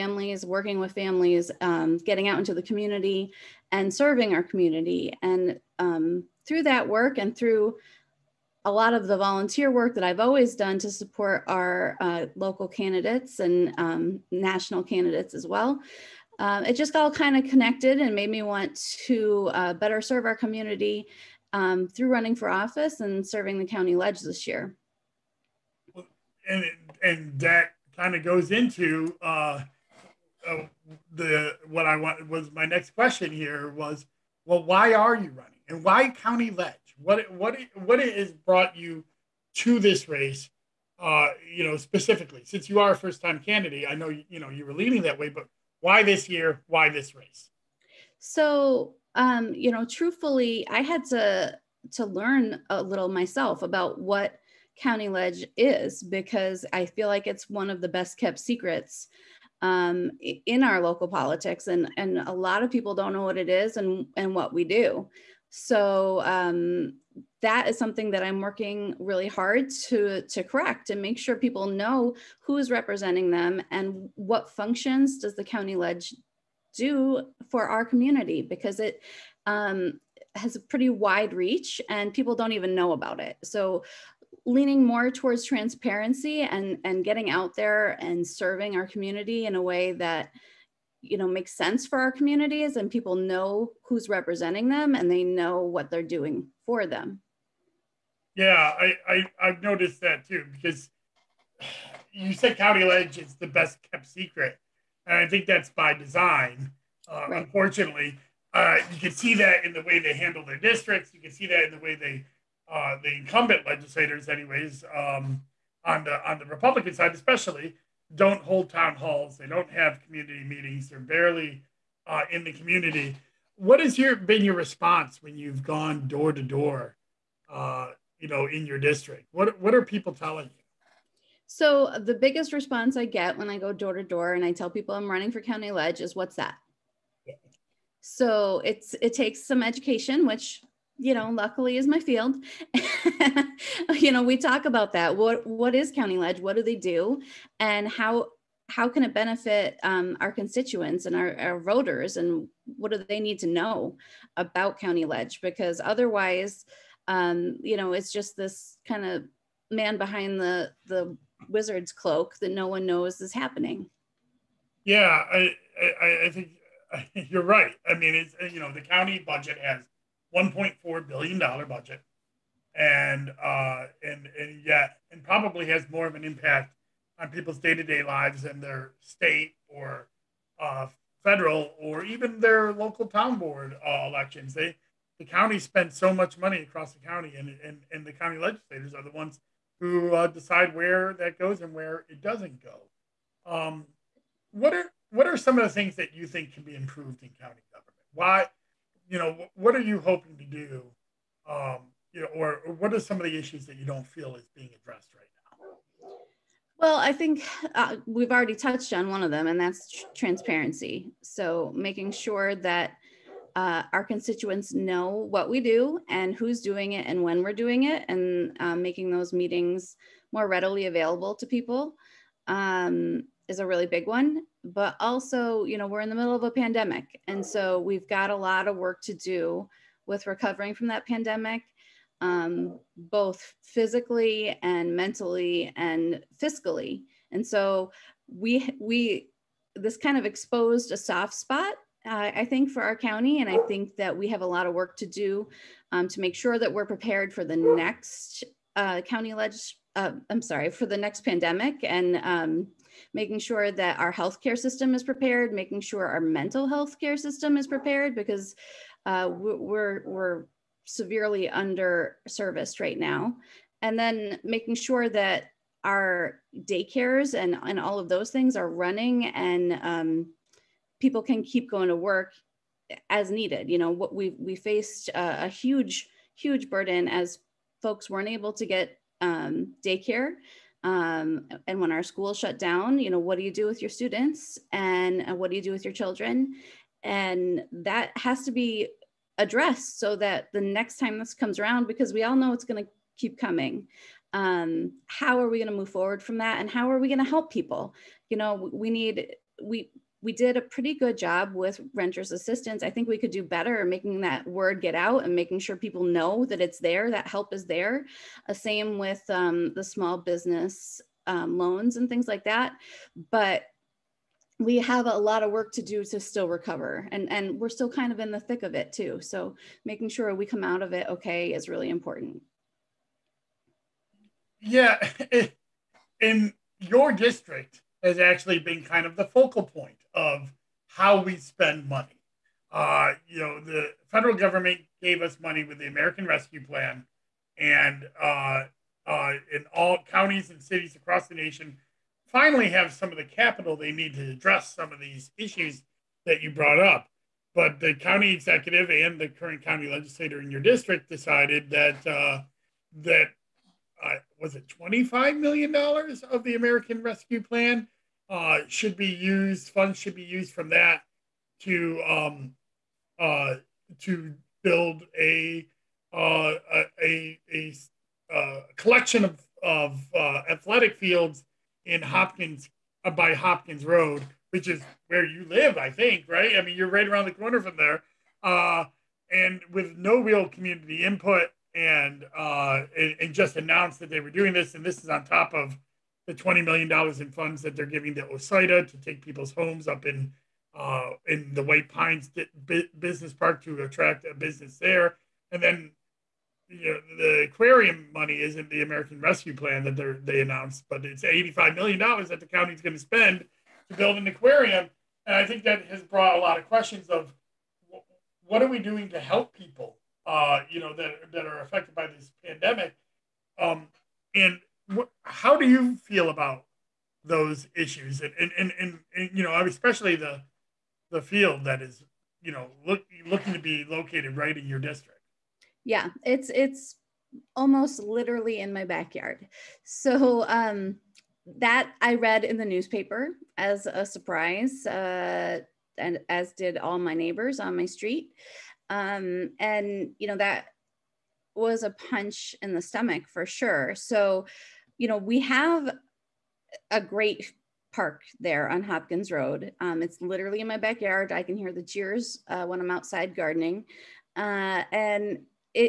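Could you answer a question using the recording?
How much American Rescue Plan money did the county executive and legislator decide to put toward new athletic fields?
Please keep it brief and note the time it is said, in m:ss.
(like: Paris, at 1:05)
25 million dollars, at 5:54.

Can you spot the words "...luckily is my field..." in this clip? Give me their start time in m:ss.
2:21.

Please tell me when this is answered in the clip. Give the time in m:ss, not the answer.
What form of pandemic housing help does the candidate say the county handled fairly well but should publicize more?
5:01.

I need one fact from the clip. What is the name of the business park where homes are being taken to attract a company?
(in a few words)
White Pines Business Park.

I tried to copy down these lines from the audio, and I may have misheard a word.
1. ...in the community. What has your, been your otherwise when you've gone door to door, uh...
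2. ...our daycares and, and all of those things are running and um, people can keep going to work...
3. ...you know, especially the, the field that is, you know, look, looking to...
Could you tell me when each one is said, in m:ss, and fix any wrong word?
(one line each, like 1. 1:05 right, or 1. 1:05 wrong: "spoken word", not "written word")
1. 2:02 wrong: "response", not "otherwise"
2. 4:25 right
3. 6:59 right.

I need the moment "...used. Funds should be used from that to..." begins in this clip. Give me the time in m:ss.
5:59.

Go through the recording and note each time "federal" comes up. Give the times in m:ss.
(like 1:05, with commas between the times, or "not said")
3:01, 5:34.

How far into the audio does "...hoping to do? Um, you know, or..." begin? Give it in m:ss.
3:19.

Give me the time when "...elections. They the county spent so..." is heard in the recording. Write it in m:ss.
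3:04.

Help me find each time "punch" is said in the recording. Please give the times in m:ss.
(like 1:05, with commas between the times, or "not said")
7:22.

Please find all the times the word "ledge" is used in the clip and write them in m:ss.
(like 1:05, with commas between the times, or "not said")
0:23, 0:36, 0:55, 1:15, 1:42, 2:15, 2:26, 2:35.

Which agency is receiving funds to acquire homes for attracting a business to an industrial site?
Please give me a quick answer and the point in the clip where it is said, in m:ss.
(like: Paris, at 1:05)
OCIDA, at 6:28.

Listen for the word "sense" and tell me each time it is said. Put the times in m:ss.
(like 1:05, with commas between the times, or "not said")
1:31.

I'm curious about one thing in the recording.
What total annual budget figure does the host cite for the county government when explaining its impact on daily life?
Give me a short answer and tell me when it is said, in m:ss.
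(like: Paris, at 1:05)
1.4 billion dollars, at 2:50.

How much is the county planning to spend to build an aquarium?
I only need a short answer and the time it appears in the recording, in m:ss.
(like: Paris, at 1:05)
85 million dollars, at 6:41.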